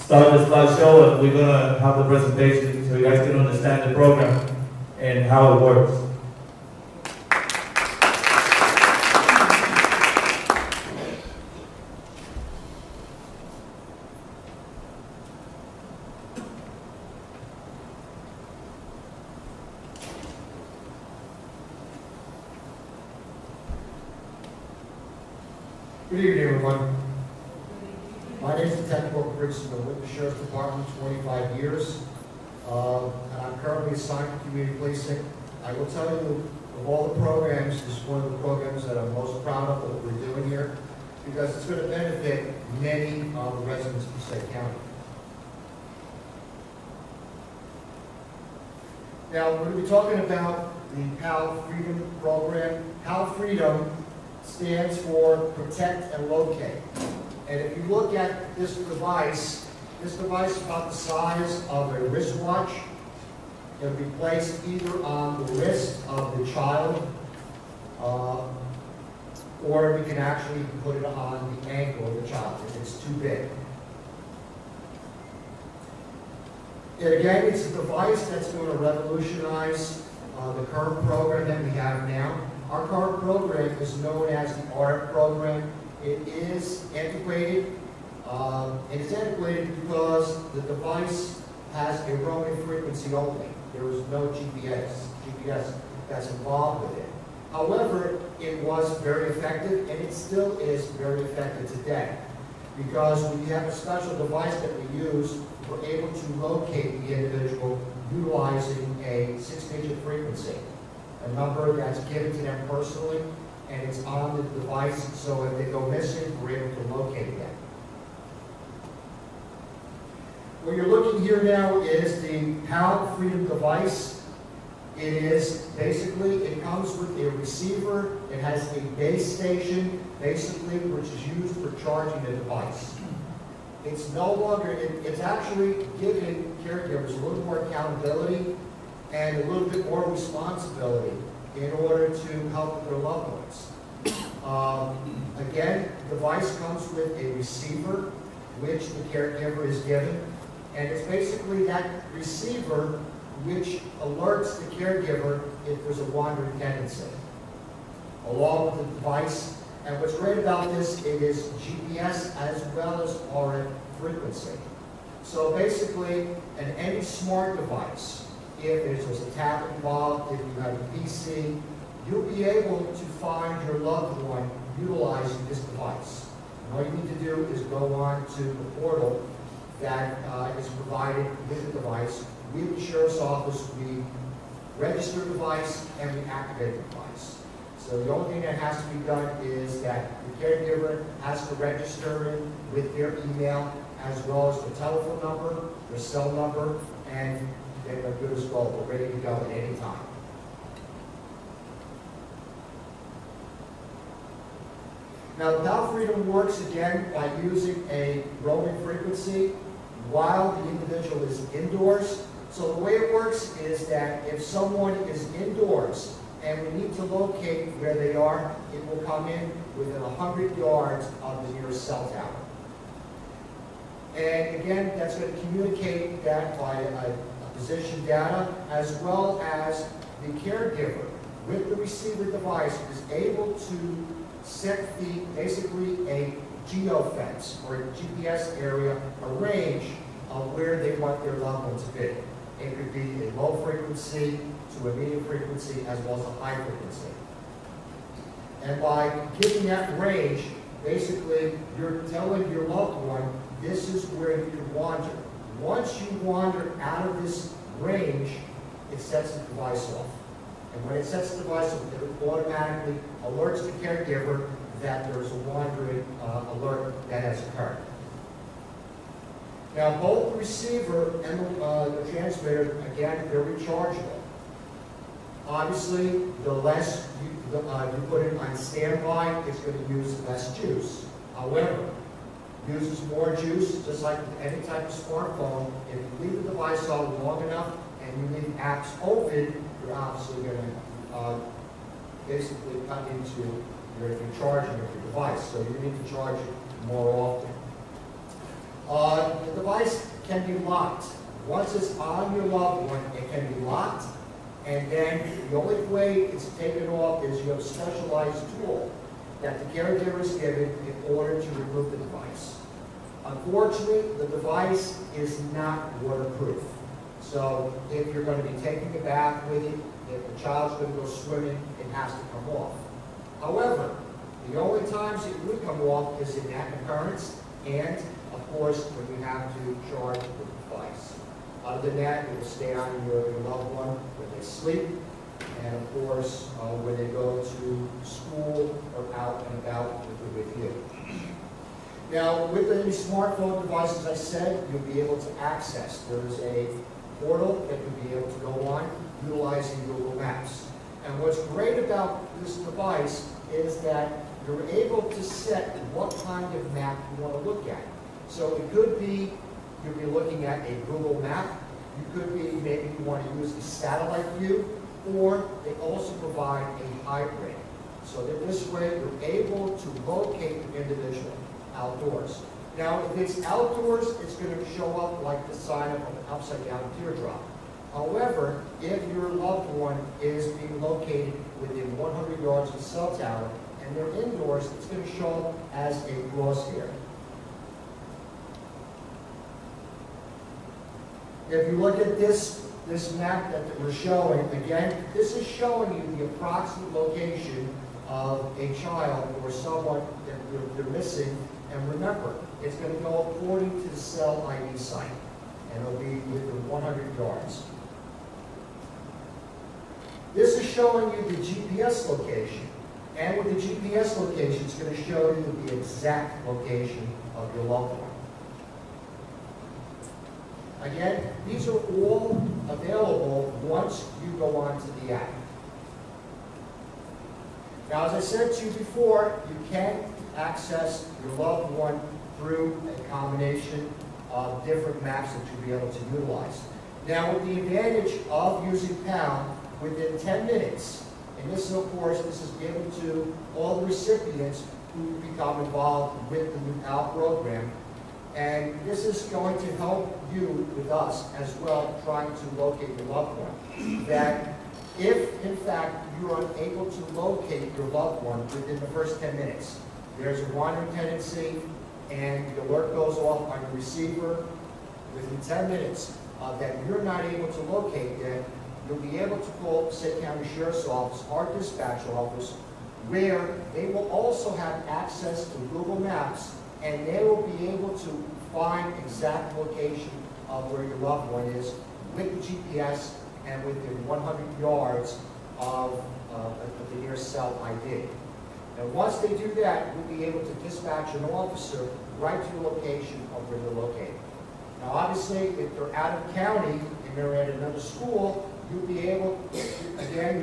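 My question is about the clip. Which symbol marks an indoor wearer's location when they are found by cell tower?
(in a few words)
crosshair.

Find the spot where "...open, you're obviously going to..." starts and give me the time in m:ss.
4:49.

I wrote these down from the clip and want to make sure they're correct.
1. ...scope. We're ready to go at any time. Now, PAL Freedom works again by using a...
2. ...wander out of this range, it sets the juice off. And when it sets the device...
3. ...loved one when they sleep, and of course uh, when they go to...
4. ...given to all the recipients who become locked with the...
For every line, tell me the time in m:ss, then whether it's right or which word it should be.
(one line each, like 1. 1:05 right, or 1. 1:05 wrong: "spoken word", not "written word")
1. 3:18 right
2. 4:16 wrong: "device", not "juice"
3. 5:33 right
4. 7:22 wrong: "involved", not "locked".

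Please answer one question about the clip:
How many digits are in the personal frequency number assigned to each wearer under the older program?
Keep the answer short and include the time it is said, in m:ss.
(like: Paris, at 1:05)
6, at 1:49.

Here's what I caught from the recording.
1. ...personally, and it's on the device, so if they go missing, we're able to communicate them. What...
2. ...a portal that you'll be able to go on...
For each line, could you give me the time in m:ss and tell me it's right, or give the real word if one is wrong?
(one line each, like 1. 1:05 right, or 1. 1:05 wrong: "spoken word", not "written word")
1. 1:52 wrong: "locate", not "communicate"
2. 5:46 right.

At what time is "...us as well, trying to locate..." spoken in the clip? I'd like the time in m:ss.
7:30.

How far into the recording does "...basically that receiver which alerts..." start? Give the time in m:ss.
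2:31.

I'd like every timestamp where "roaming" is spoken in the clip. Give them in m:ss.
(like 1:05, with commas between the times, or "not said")
1:32, 3:28.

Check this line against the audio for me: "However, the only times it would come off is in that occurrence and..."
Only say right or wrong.
right.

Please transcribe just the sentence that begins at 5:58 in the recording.
So it could be you'll be looking at a Google map.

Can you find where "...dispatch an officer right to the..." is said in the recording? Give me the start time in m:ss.
8:10.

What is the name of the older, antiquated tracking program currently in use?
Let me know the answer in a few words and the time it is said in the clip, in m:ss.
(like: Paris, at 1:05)
ART program, at 1:24.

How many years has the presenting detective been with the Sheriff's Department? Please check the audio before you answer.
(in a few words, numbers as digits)
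25.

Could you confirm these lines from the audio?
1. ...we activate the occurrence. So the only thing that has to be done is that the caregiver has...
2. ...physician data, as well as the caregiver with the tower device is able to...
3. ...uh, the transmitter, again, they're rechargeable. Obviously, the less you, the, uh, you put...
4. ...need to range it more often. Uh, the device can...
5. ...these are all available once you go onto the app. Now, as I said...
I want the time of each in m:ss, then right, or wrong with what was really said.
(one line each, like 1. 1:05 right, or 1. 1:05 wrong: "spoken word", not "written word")
1. 3:06 wrong: "device", not "occurrence"
2. 3:47 wrong: "receiver", not "tower"
3. 4:31 right
4. 4:55 wrong: "charge", not "range"
5. 7:01 right.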